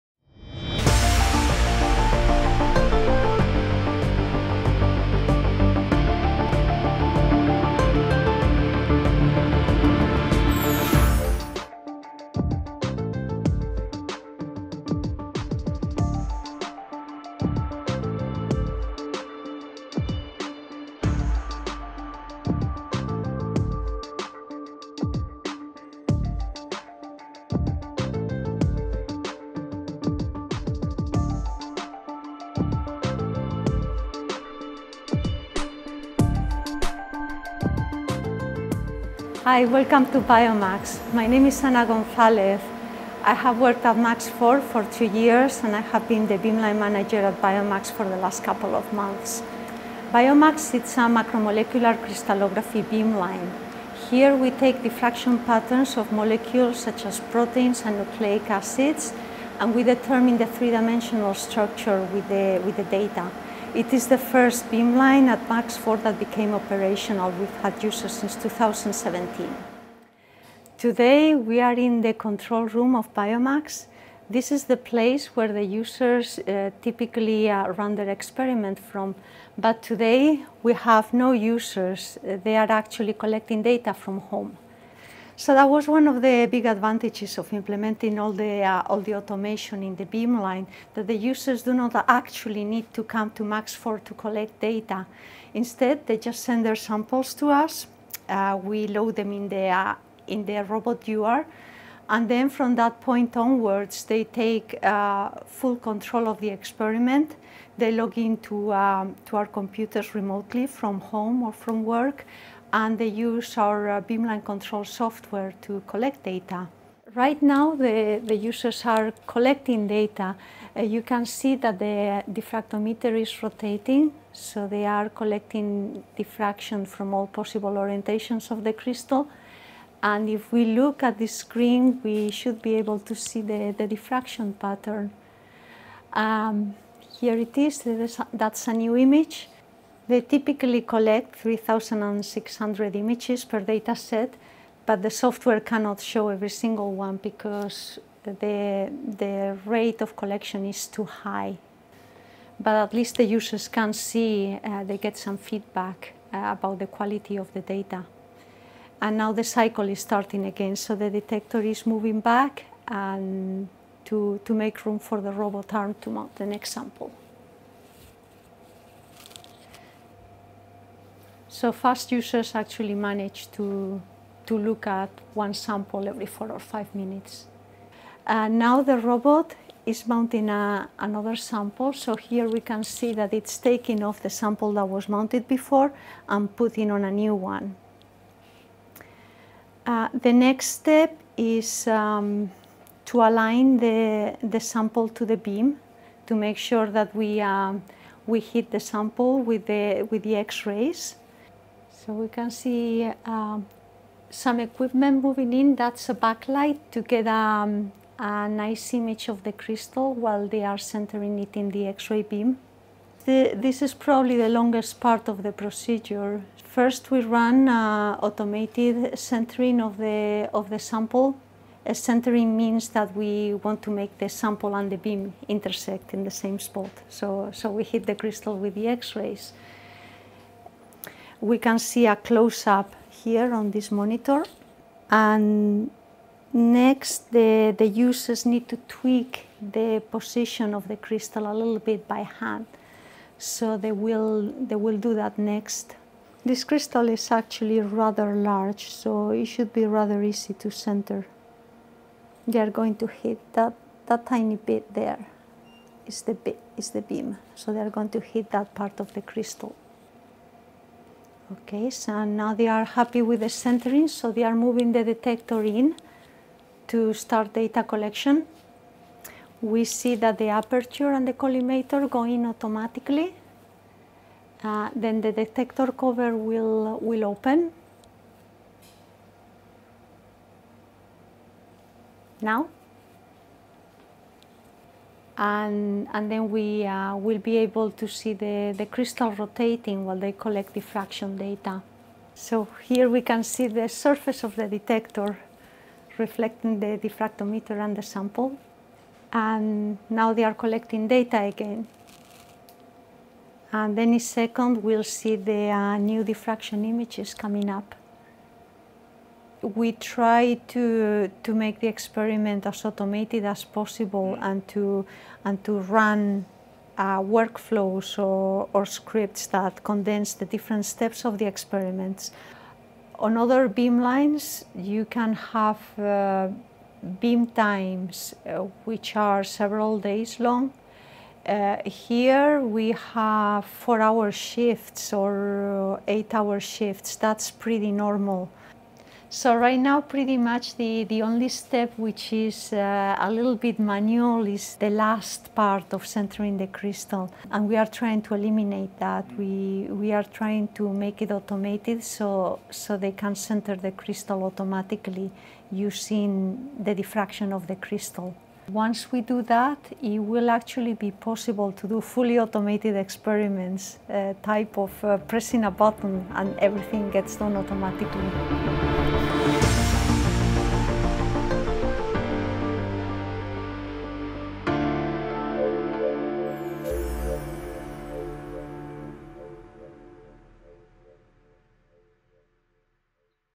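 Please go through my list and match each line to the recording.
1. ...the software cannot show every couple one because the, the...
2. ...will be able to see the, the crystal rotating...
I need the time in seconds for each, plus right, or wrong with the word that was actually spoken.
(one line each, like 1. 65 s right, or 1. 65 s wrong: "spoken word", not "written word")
1. 145 s wrong: "single", not "couple"
2. 287 s right.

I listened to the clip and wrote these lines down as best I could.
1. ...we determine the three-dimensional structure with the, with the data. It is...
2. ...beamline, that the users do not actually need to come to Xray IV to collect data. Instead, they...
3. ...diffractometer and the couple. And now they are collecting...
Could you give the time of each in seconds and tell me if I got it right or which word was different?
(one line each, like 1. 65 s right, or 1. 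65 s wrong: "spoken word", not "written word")
1. 59 s right
2. 90 s wrong: "MAX", not "Xray"
3. 296 s wrong: "sample", not "couple".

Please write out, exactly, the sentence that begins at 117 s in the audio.
Right now, the, the users are collecting data.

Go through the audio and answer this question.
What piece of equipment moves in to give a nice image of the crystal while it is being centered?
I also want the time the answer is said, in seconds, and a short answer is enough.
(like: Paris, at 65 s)
A backlight, at 206 s.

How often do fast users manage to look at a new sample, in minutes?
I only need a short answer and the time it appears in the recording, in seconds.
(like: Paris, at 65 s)
4 or 5 minutes, at 176 s.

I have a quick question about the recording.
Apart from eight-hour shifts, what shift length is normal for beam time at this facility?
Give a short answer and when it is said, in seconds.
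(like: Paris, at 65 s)
4 hours, at 333 s.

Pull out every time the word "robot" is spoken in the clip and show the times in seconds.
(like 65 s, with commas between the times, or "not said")
100 s, 165 s, 178 s.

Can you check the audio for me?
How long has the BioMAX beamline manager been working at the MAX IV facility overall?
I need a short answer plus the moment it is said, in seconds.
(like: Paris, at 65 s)
2 years, at 44 s.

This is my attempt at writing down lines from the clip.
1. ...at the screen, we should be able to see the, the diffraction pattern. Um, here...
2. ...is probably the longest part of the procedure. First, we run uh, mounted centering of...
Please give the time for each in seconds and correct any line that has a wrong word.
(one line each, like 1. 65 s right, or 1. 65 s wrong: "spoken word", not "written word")
1. 131 s right
2. 213 s wrong: "automated", not "mounted".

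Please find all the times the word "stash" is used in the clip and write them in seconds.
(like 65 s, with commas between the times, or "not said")
not said.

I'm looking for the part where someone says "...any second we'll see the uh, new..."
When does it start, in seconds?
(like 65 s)
303 s.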